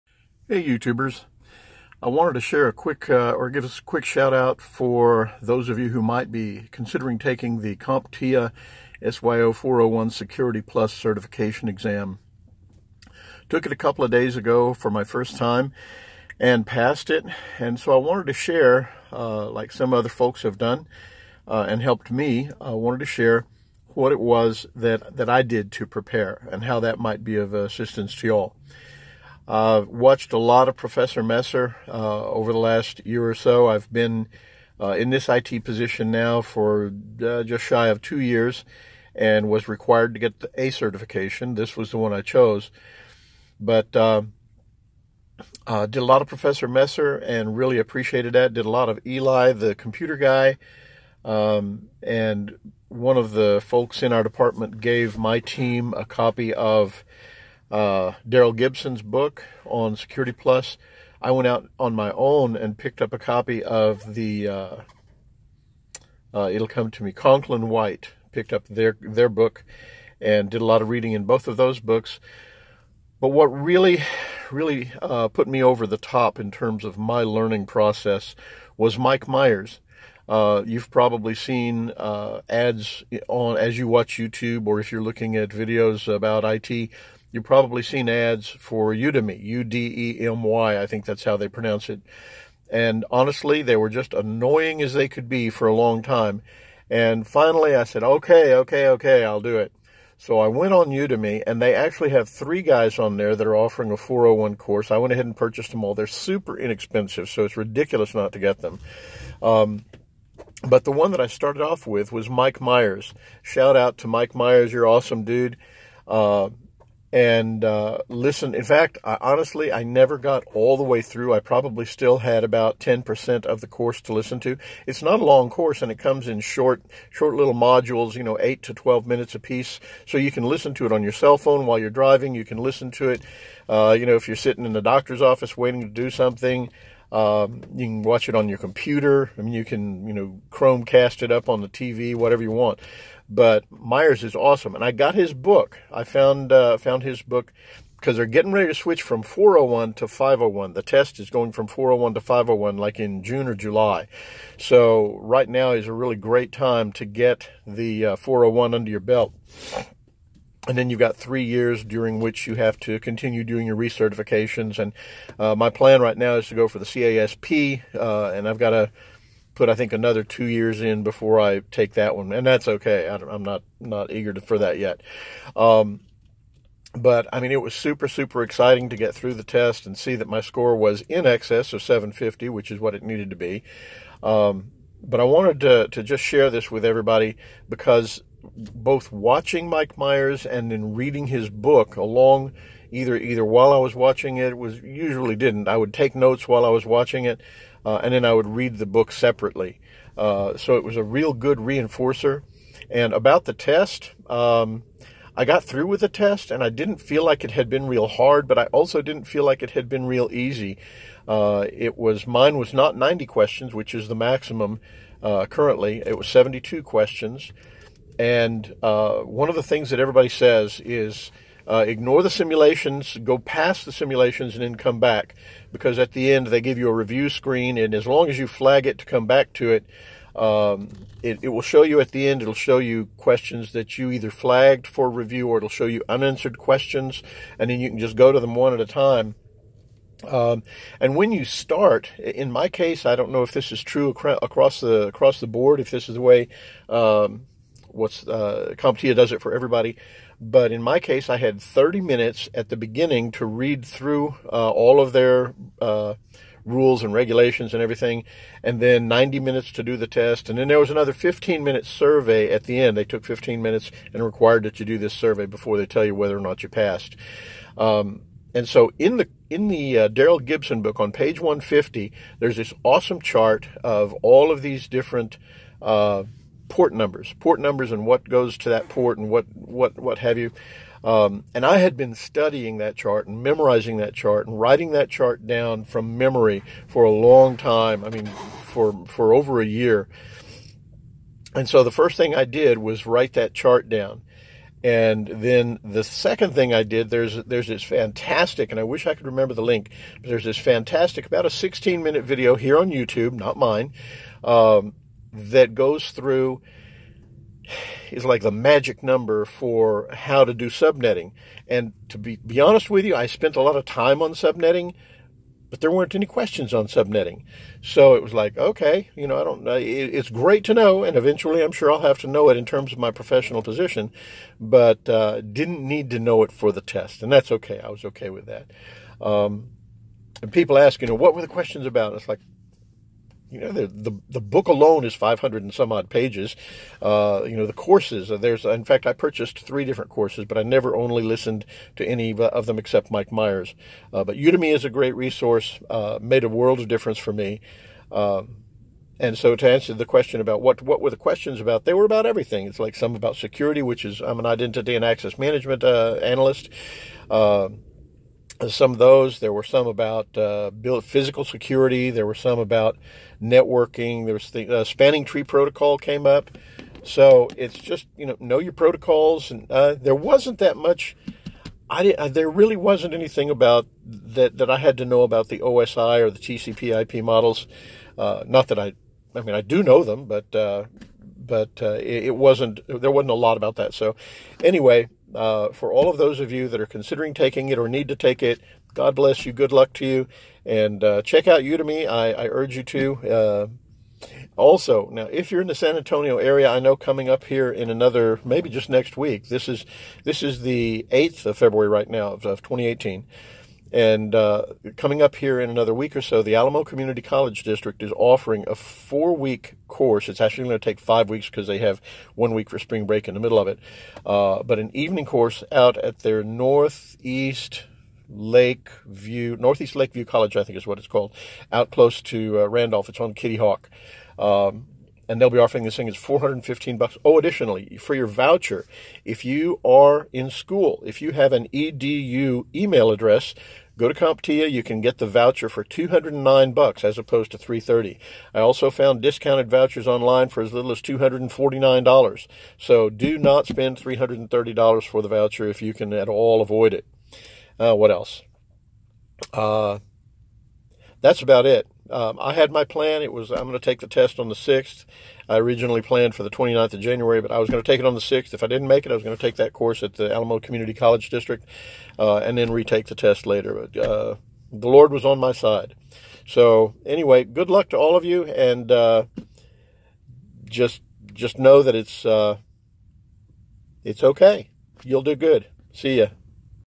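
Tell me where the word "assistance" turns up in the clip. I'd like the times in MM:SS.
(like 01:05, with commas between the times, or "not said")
00:27.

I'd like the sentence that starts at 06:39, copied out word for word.
This is this is the eighth of February right now of, of 2018.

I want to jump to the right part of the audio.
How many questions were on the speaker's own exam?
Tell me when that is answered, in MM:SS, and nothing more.
03:36.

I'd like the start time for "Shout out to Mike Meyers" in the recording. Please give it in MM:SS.
01:53.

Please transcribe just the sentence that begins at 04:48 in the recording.
I mean, for for over a year.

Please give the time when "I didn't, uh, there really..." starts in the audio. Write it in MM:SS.
06:11.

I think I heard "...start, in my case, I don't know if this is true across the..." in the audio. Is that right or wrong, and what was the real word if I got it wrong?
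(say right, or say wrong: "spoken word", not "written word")
right.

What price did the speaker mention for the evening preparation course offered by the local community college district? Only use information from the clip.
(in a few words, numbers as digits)
$415.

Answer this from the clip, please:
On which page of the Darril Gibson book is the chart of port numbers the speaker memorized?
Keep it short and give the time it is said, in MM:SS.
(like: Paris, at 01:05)
150, at 04:31.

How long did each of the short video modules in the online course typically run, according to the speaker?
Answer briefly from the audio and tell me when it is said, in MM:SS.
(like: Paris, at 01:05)
8 to 12 minutes, at 02:08.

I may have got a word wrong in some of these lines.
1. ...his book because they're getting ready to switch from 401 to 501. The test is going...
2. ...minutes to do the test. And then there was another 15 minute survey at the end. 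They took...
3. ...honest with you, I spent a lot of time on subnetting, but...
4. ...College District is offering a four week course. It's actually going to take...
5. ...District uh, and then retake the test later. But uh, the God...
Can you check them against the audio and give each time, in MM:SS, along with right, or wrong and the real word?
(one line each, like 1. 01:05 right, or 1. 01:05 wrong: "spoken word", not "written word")
1. 02:27 right
2. 04:19 right
3. 05:12 right
4. 06:47 right
5. 07:41 wrong: "Lord", not "God".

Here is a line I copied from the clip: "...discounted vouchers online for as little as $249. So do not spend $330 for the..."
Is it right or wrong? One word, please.
right.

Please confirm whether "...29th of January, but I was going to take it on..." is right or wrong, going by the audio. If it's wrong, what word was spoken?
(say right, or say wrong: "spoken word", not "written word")
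right.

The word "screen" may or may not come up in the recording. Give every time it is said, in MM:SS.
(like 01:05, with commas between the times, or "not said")
03:47.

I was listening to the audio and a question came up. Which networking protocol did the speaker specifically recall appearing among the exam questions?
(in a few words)
spanning tree protocol.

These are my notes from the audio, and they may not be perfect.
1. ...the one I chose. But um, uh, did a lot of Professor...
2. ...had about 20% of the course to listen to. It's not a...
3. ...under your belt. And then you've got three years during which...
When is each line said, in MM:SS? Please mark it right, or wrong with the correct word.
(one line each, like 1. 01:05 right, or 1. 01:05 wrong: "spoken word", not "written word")
1. 00:41 right
2. 02:02 wrong: "10", not "20"
3. 02:38 right.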